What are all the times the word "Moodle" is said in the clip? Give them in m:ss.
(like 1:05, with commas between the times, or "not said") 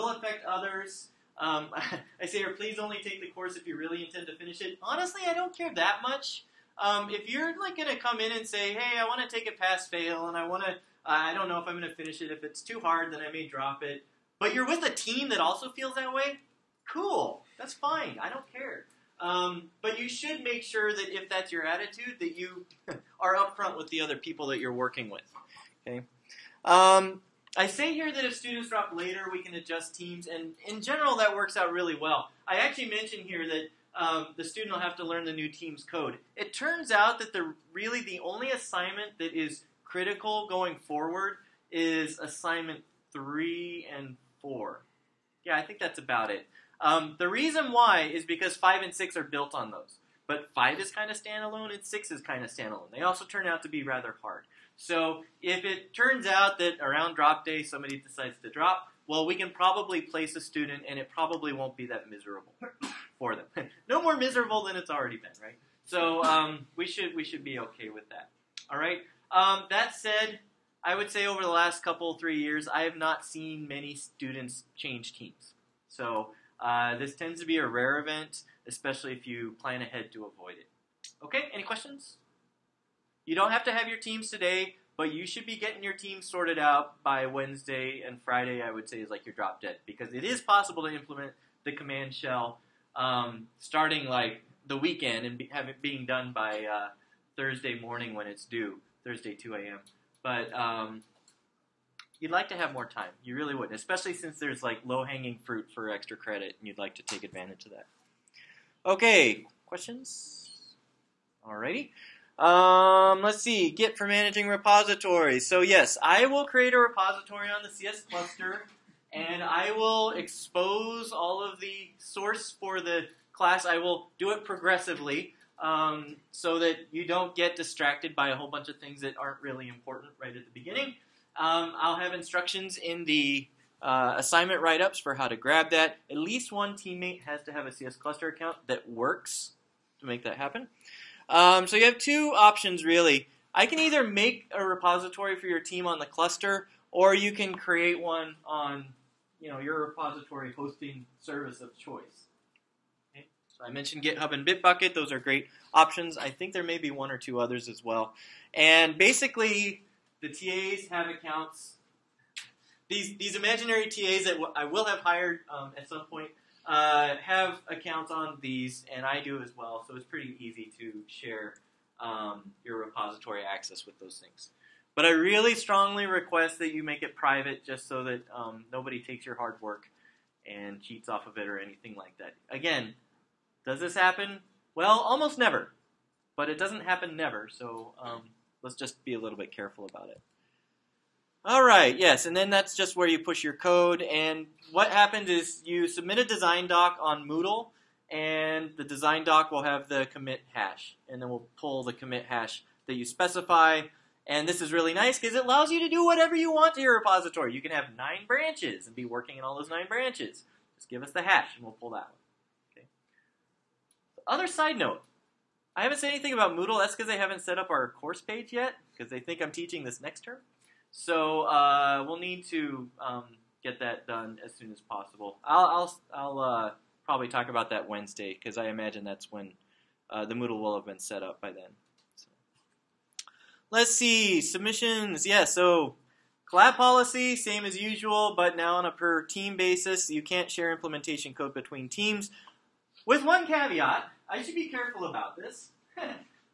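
3:17, 3:36, 3:50.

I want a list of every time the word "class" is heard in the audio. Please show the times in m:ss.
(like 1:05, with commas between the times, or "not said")
2:03.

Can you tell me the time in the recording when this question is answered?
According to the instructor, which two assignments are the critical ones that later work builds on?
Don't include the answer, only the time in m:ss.
0:42.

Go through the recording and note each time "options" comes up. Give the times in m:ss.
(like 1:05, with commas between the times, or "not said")
2:22, 2:35.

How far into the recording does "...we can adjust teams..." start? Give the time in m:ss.
0:29.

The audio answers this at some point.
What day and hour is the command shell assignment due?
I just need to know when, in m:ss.
1:39.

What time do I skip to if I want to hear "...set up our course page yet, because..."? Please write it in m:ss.
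3:37.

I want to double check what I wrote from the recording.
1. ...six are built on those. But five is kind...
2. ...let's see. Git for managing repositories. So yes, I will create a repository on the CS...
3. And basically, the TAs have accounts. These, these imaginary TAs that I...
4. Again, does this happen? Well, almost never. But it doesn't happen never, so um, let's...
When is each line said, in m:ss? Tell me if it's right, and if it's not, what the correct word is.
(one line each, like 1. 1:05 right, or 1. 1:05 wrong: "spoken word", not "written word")
1. 0:48 right
2. 1:53 right
3. 2:38 right
4. 3:02 right.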